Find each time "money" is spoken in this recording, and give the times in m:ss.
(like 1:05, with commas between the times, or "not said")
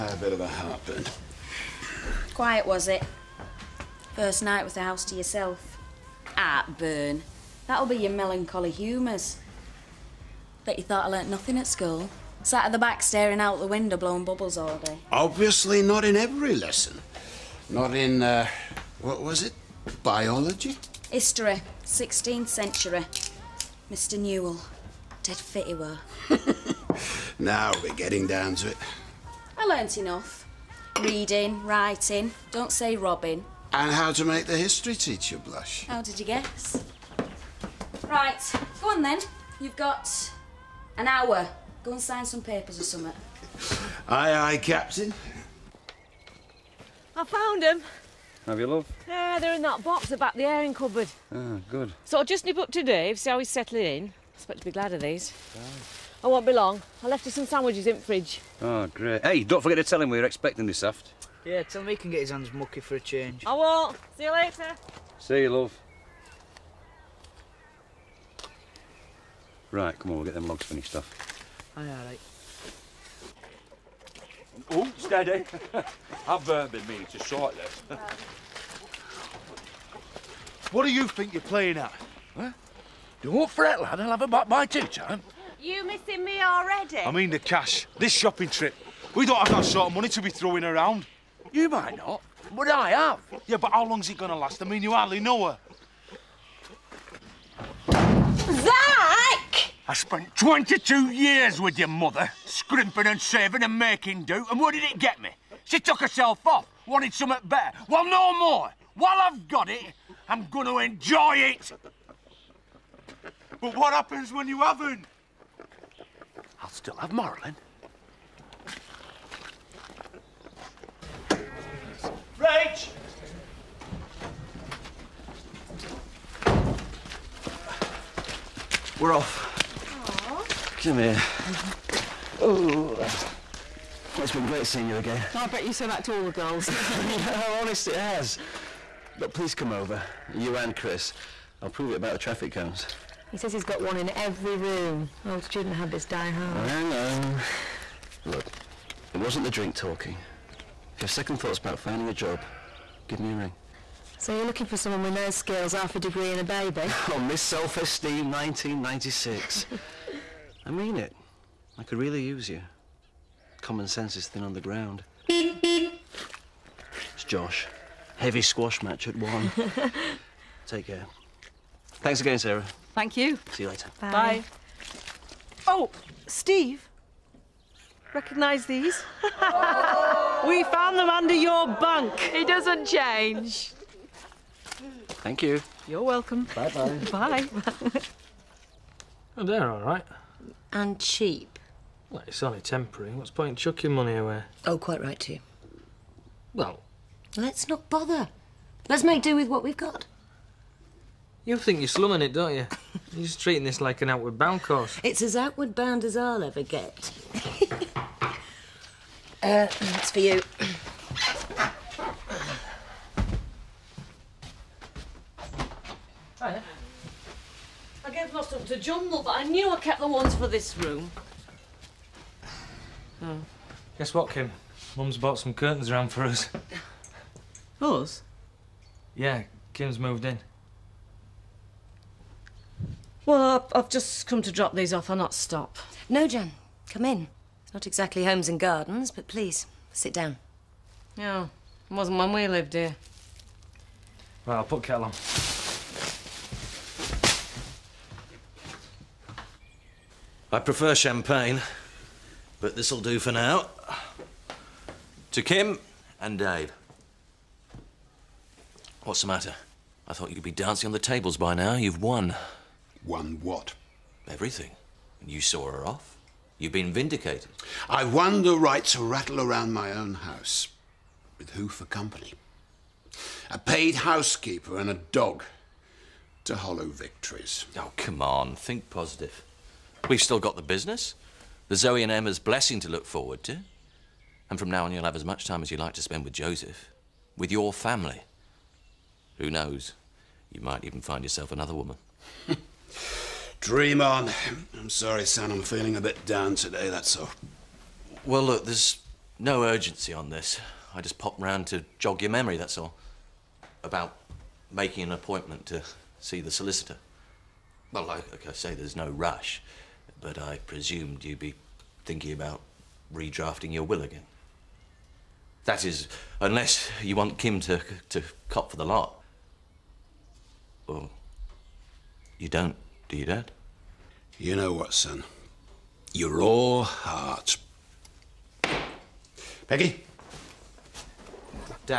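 1:29, 3:13.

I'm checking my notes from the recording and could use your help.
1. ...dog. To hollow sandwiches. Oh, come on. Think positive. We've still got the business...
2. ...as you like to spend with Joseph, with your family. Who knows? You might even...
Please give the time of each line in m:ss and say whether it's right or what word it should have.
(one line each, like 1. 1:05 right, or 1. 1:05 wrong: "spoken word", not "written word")
1. 4:35 wrong: "victories", not "sandwiches"
2. 4:45 right.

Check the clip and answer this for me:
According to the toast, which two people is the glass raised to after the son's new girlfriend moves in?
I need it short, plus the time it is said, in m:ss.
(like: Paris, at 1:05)
Kim and Dave, at 4:15.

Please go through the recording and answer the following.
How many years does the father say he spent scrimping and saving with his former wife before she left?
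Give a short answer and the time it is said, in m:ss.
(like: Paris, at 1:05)
22, at 1:40.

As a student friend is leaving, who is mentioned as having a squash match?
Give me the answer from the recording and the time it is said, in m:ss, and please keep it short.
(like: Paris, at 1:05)
Josh, at 2:47.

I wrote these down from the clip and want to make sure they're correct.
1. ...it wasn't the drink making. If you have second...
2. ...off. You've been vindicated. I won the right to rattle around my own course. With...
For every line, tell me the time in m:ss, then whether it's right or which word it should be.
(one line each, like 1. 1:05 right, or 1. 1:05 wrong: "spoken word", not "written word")
1. 2:29 wrong: "talking", not "making"
2. 4:25 wrong: "house", not "course".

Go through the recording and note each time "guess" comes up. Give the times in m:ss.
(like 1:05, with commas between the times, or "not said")
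0:36, 3:43.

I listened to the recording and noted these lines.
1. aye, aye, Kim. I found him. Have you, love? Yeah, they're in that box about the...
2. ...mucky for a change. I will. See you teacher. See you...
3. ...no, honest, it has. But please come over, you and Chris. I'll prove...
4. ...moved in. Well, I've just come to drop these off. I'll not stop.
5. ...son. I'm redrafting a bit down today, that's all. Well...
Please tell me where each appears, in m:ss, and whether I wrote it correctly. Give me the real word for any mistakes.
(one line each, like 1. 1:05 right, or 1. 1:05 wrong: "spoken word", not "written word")
1. 0:44 wrong: "Captain", not "Kim"
2. 1:02 wrong: "later", not "teacher"
3. 2:16 right
4. 3:49 right
5. 4:55 wrong: "feeling", not "redrafting".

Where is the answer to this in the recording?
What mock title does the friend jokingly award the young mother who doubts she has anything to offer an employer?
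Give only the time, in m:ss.
2:37.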